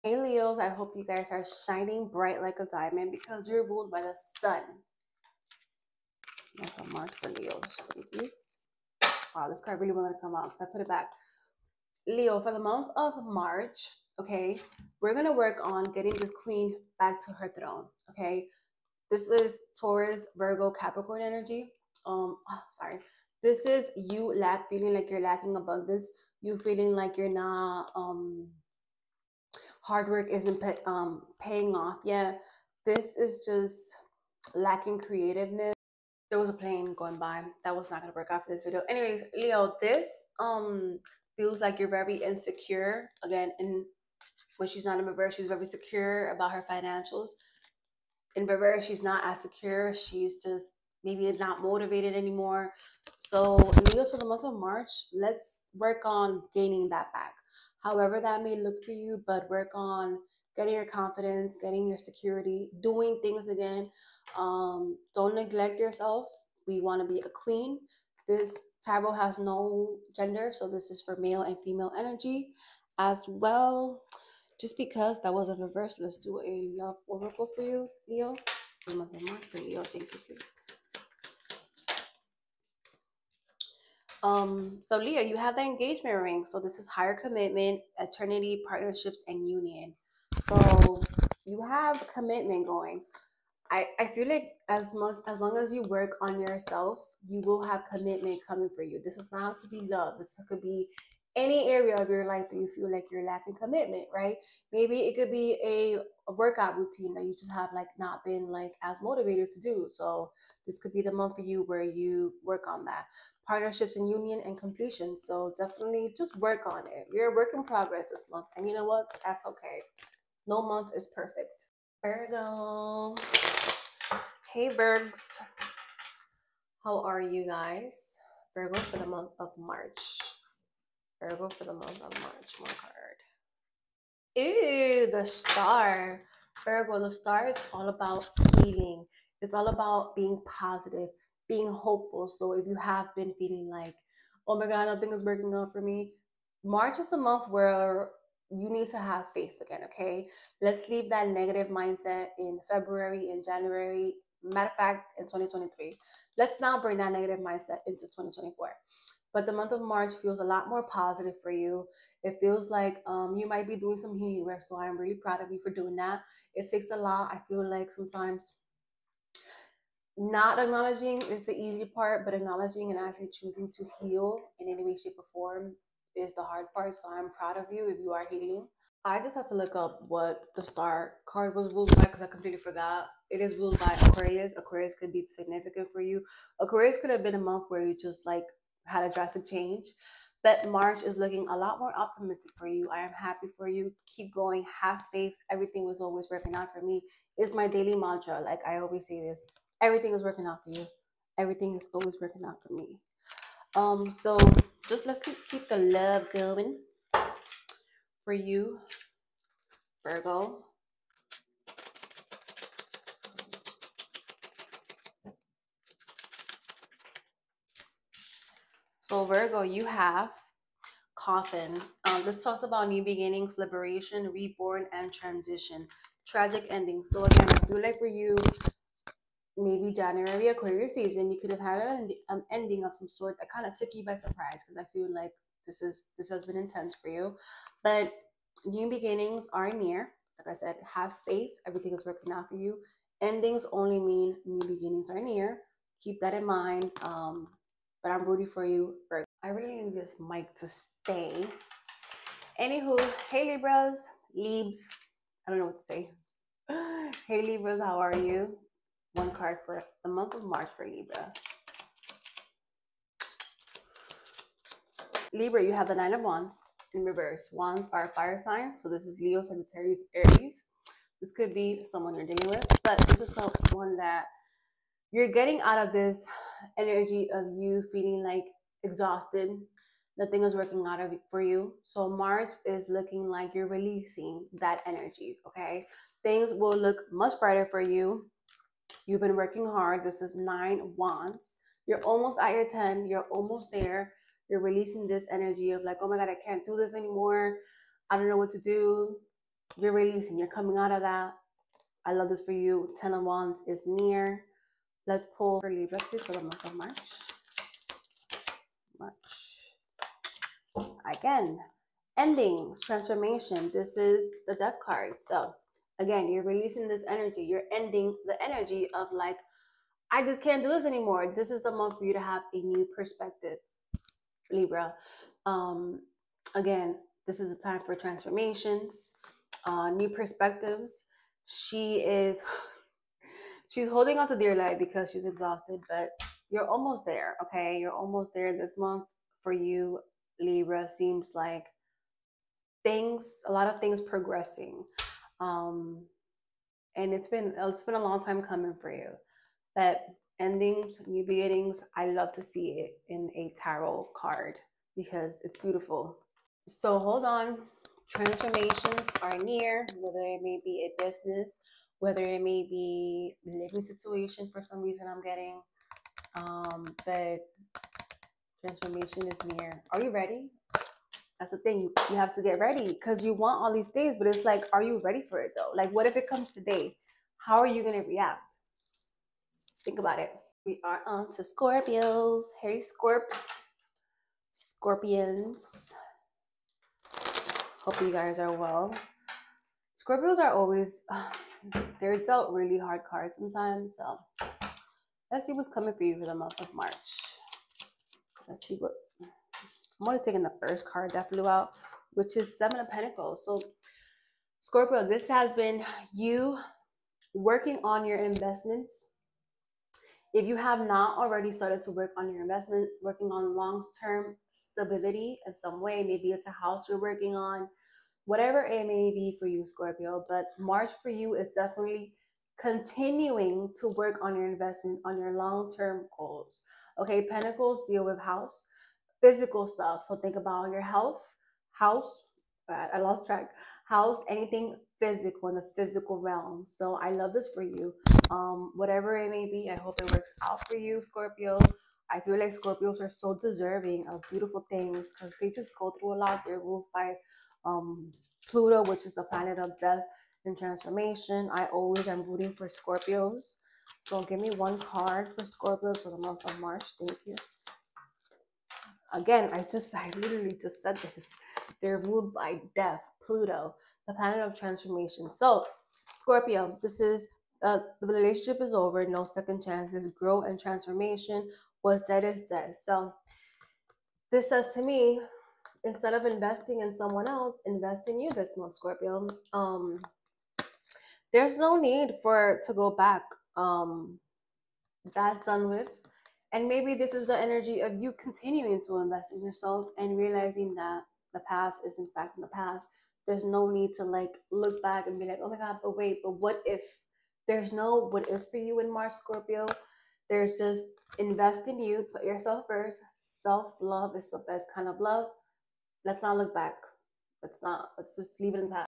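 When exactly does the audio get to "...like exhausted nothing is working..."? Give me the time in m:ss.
4:38.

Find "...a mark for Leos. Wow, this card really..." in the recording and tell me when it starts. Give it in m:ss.
0:06.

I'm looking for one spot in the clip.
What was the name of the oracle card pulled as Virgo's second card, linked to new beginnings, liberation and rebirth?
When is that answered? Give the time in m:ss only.
3:41.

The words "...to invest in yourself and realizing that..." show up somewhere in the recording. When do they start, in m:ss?
8:08.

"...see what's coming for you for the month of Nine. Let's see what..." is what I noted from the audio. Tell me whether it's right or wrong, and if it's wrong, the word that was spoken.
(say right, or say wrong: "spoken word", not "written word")
wrong: "March", not "Nine".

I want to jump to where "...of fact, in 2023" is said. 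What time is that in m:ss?
2:34.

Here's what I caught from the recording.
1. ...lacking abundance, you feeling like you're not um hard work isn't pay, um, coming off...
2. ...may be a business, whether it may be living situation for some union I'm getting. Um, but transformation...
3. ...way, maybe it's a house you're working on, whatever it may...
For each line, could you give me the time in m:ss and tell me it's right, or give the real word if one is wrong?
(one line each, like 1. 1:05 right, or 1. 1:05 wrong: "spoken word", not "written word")
1. 0:25 wrong: "paying", not "coming"
2. 6:00 wrong: "reason", not "union"
3. 6:55 right.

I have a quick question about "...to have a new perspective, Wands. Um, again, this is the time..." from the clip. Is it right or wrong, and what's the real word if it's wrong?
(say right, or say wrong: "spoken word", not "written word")
wrong: "Libra", not "Wands".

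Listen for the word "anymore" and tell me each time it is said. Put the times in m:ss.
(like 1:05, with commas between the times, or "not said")
0:52, 4:56, 5:20.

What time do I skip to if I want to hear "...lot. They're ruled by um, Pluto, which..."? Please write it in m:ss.
7:26.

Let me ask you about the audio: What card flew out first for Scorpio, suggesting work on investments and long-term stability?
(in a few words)
Seven of Pentacles.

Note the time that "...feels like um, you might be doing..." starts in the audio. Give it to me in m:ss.
2:42.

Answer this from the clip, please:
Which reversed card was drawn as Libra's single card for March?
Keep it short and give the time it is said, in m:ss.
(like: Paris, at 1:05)
Nine of Wands, at 4:25.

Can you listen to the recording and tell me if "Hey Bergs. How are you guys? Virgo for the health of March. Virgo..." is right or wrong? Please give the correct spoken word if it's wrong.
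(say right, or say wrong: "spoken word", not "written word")
wrong: "month", not "health".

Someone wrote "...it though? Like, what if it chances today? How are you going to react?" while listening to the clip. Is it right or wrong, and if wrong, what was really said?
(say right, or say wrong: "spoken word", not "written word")
wrong: "comes", not "chances".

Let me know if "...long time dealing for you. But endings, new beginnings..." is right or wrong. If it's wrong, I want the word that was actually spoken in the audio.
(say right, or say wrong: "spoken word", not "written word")
wrong: "coming", not "dealing".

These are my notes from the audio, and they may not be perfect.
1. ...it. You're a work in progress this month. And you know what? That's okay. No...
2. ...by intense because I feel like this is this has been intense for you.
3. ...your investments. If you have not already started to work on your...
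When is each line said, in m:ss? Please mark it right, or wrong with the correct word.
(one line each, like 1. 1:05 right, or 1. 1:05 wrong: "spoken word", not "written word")
1. 1:56 right
2. 3:54 wrong: "surprise", not "intense"
3. 6:48 right.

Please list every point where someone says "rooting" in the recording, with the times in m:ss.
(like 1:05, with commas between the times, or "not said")
4:08, 7:32.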